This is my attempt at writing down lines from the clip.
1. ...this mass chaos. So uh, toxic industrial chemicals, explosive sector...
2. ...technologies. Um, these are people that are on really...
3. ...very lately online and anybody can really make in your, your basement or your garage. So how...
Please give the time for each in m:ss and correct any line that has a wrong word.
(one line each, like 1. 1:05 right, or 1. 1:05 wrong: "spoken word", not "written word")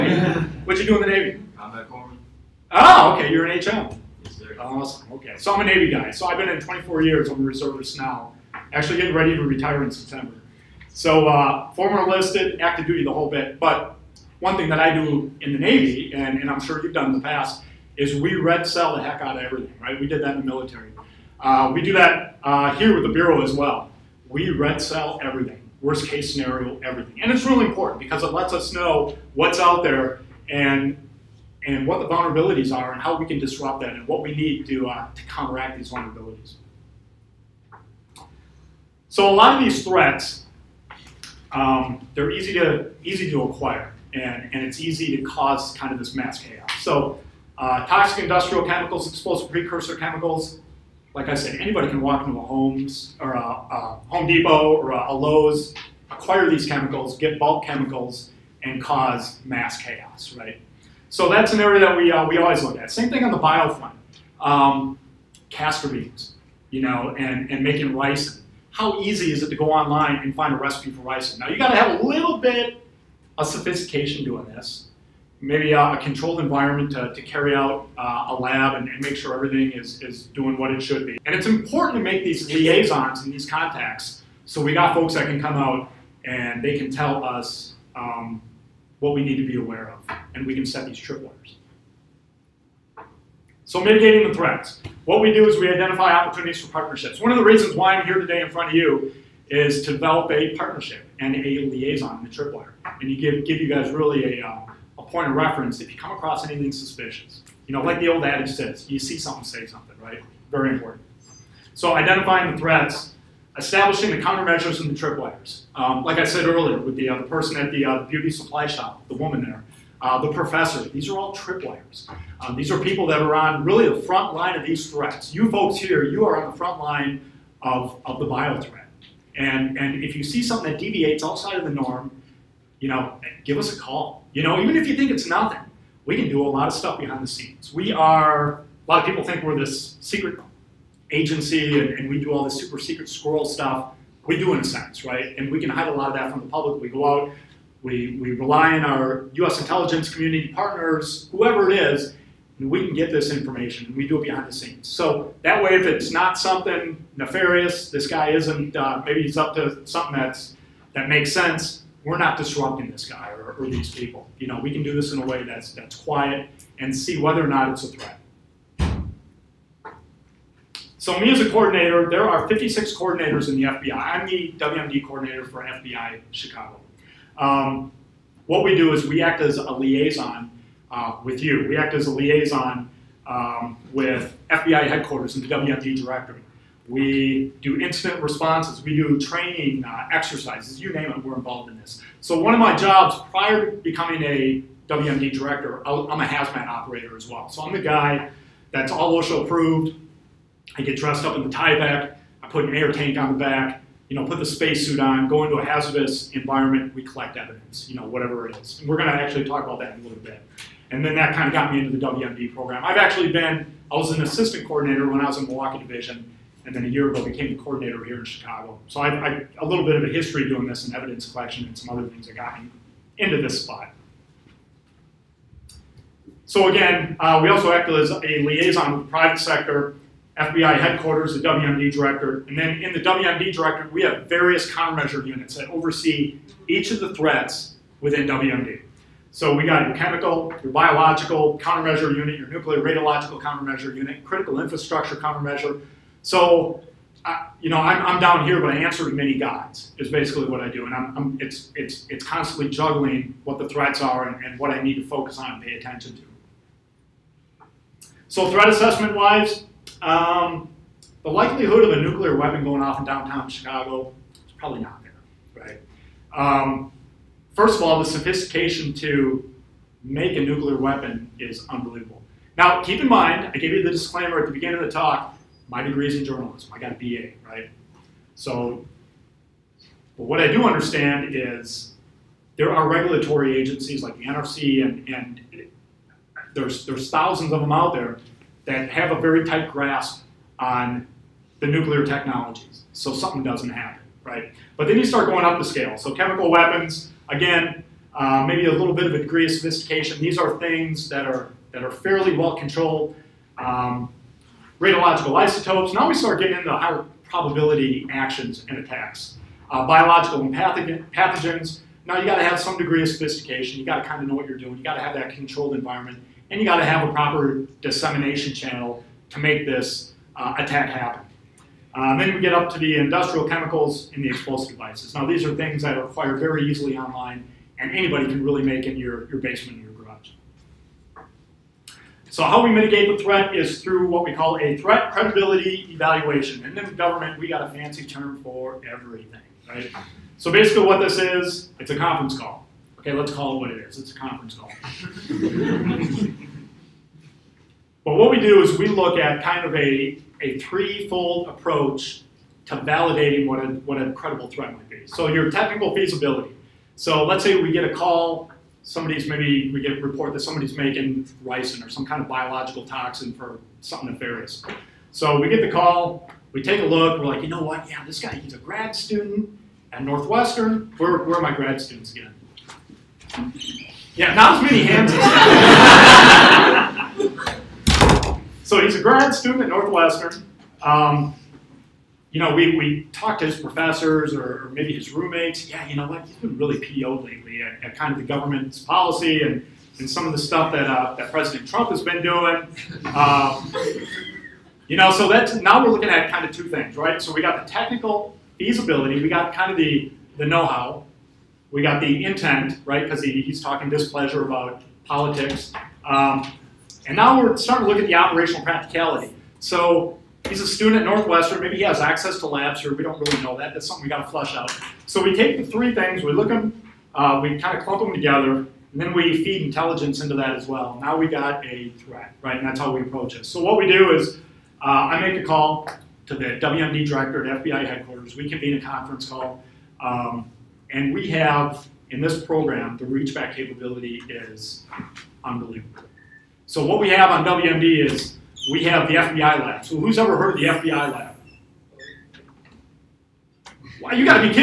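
1. 0:45 wrong: "precursor", not "sector"
2. 2:01 wrong: "tripwires", not "technologies"
3. 5:26 wrong: "easily", not "lately".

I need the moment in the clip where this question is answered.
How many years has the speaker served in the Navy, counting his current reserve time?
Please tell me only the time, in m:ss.
0:06.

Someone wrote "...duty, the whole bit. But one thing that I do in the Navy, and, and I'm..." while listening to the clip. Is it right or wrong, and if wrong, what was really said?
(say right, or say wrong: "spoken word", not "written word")
right.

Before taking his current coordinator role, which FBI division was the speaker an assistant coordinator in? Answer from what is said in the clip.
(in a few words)
Milwaukee.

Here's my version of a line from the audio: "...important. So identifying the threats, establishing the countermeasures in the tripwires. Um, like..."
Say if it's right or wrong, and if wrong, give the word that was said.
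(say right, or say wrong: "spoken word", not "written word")
right.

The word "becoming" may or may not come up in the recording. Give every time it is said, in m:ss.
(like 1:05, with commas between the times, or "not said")
3:13.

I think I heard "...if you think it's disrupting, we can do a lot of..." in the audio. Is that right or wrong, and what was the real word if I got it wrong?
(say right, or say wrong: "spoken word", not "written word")
wrong: "nothing", not "disrupting".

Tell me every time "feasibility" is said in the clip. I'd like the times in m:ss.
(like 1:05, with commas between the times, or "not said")
5:55, 6:38.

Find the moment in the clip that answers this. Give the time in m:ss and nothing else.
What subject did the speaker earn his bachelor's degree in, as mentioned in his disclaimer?
4:36.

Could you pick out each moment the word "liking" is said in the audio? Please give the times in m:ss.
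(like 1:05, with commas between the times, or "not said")
not said.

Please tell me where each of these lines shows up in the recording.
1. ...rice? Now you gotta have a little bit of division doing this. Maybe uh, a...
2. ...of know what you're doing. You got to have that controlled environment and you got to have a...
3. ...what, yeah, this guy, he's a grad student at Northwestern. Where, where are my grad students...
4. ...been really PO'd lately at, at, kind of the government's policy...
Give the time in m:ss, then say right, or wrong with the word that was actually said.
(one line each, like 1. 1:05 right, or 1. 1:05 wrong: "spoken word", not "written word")
1. 1:11 wrong: "sophistication", not "division"
2. 5:14 right
3. 6:07 right
4. 6:26 right.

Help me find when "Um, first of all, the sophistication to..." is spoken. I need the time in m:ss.
4:26.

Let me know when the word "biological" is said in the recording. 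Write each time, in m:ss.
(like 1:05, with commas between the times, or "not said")
4:00, 5:09, 6:02.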